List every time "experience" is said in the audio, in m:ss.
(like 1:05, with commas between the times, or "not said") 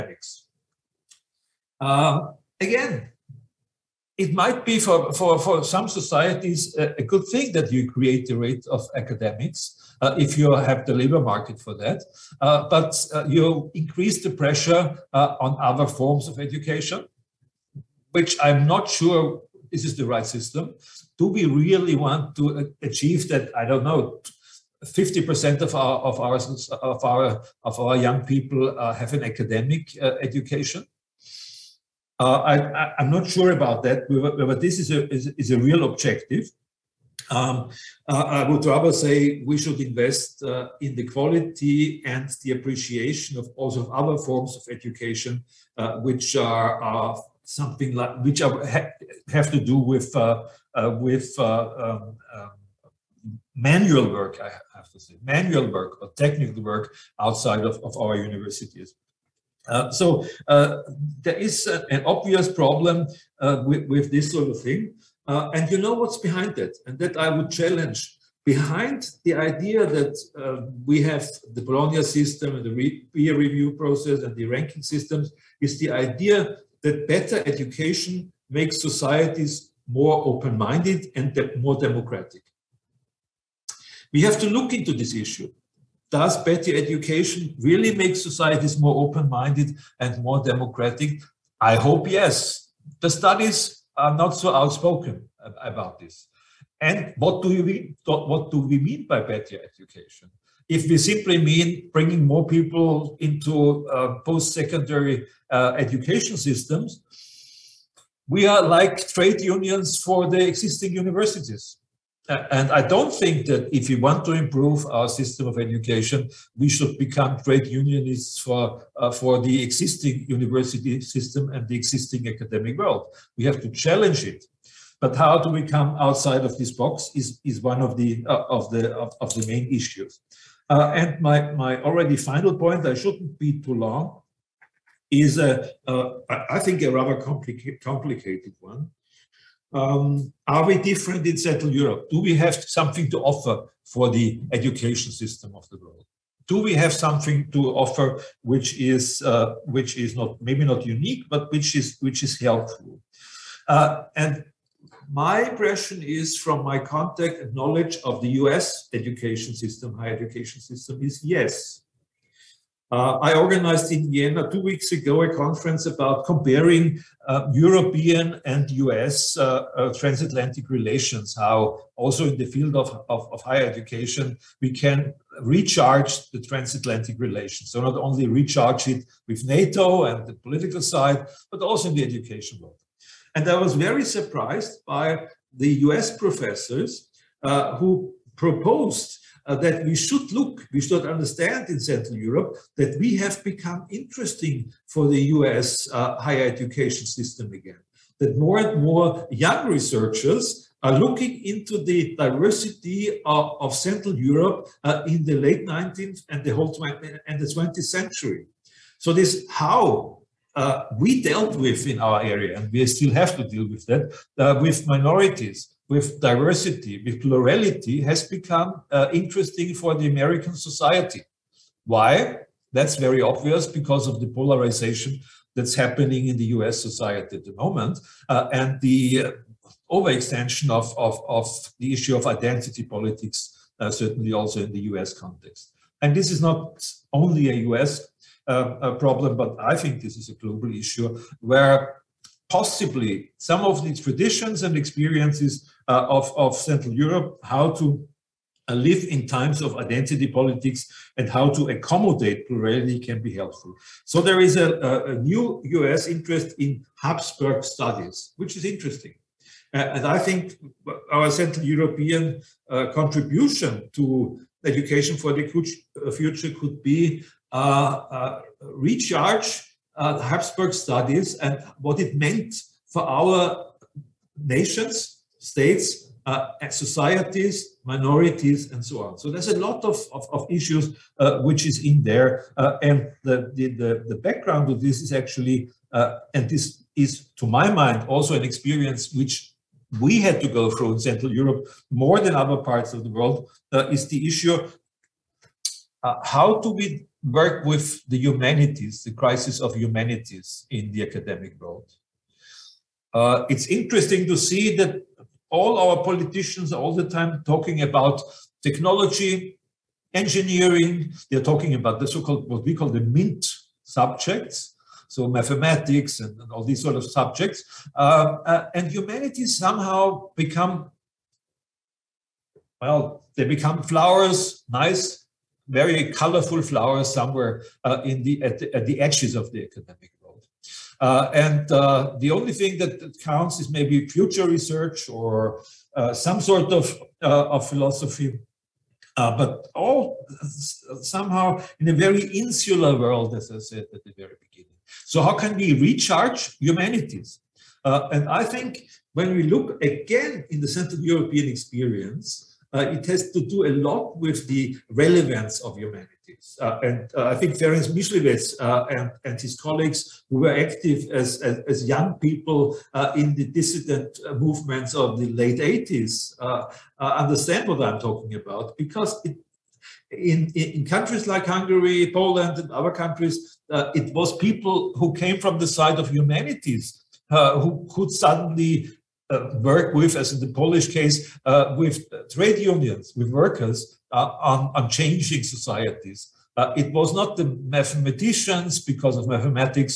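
4:04, 4:48, 5:51.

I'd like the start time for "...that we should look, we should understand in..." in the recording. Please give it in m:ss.
3:09.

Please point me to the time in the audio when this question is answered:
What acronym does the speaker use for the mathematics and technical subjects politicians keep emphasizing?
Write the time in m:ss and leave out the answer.
5:13.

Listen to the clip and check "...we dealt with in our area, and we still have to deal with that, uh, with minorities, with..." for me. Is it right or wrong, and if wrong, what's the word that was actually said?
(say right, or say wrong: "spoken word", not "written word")
right.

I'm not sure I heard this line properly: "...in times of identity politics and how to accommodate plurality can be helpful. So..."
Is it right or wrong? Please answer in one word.
right.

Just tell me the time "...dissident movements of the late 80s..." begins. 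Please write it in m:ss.
6:03.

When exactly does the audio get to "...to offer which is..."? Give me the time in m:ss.
2:27.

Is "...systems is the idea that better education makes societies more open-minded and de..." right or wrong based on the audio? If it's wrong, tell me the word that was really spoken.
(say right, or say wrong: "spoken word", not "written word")
right.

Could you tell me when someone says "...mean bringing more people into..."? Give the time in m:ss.
1:41.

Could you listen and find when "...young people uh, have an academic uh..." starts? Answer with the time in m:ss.
0:28.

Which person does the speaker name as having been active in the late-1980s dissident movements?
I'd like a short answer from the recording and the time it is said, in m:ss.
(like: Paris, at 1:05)
Ferenc Miszlivetz, at 5:57.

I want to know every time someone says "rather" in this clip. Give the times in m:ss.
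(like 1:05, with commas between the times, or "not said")
0:38, 2:16.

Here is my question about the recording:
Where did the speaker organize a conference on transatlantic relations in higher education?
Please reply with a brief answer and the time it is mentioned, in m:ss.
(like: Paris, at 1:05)
Vienna, at 2:44.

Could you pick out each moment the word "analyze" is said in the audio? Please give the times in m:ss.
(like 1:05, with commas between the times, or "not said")
not said.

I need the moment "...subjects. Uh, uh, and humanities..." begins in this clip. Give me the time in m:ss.
5:17.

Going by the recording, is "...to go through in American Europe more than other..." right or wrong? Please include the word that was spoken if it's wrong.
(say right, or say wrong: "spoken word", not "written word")
wrong: "Central", not "American".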